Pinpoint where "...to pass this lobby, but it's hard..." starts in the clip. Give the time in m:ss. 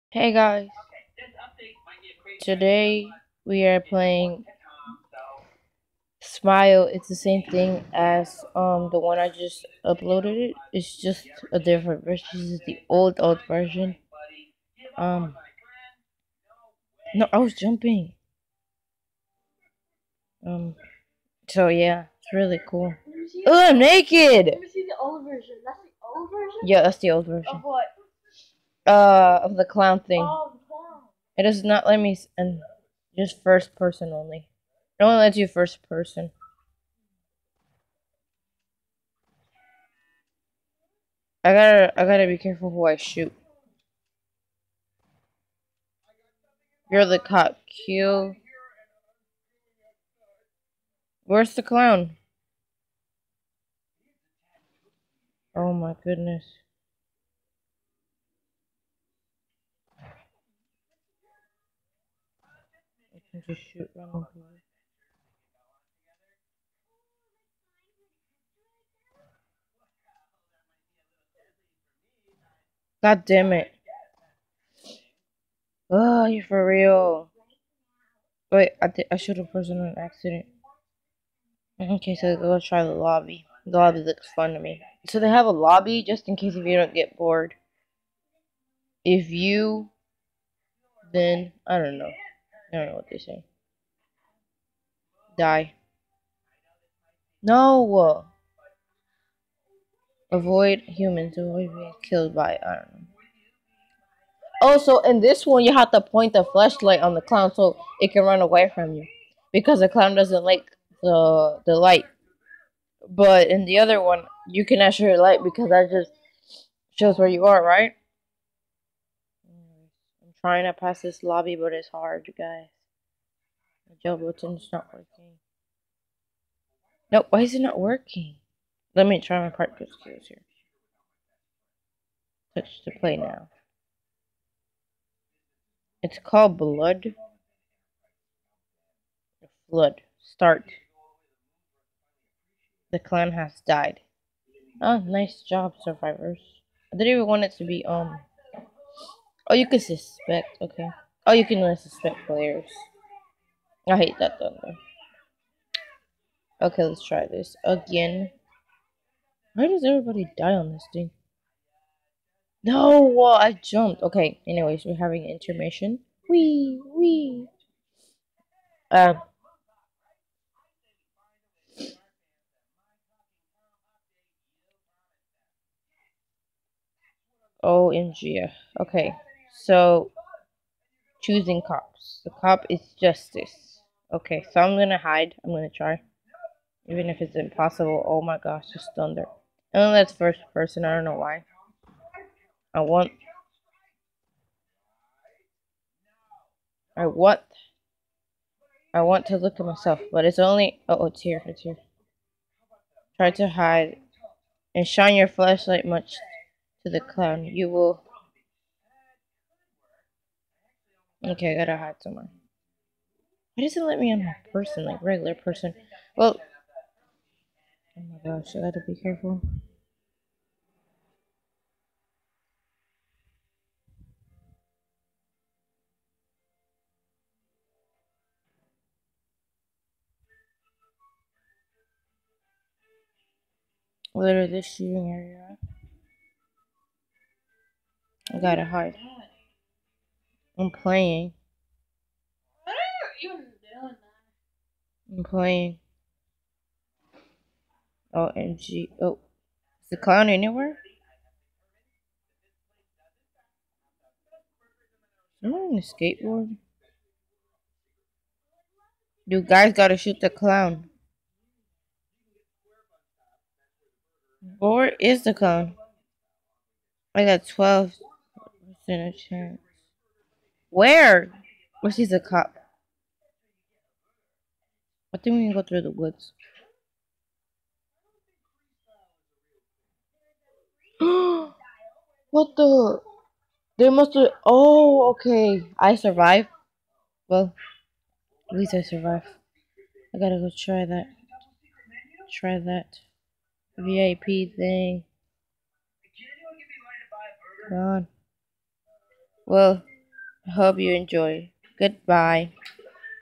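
2:00.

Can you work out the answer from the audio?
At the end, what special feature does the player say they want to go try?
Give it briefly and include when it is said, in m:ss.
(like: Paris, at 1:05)
VIP, at 4:53.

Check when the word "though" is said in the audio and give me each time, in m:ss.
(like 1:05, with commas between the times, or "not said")
2:34.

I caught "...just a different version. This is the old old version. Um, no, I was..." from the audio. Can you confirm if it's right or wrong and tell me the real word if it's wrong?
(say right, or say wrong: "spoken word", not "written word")
right.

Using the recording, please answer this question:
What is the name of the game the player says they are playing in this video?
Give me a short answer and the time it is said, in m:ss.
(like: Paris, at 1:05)
Smile, at 0:06.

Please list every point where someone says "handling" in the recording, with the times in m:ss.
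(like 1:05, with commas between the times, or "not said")
not said.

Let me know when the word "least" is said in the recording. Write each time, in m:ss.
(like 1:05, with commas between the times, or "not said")
4:48.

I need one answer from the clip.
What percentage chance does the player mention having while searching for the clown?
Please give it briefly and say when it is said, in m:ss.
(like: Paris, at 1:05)
12 percent, at 4:27.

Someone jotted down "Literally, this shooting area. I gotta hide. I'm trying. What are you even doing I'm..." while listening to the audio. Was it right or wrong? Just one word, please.
wrong.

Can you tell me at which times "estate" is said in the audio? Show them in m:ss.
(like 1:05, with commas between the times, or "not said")
not said.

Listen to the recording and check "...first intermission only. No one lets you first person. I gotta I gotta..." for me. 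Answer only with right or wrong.
wrong.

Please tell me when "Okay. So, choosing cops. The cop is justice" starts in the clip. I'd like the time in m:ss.
2:58.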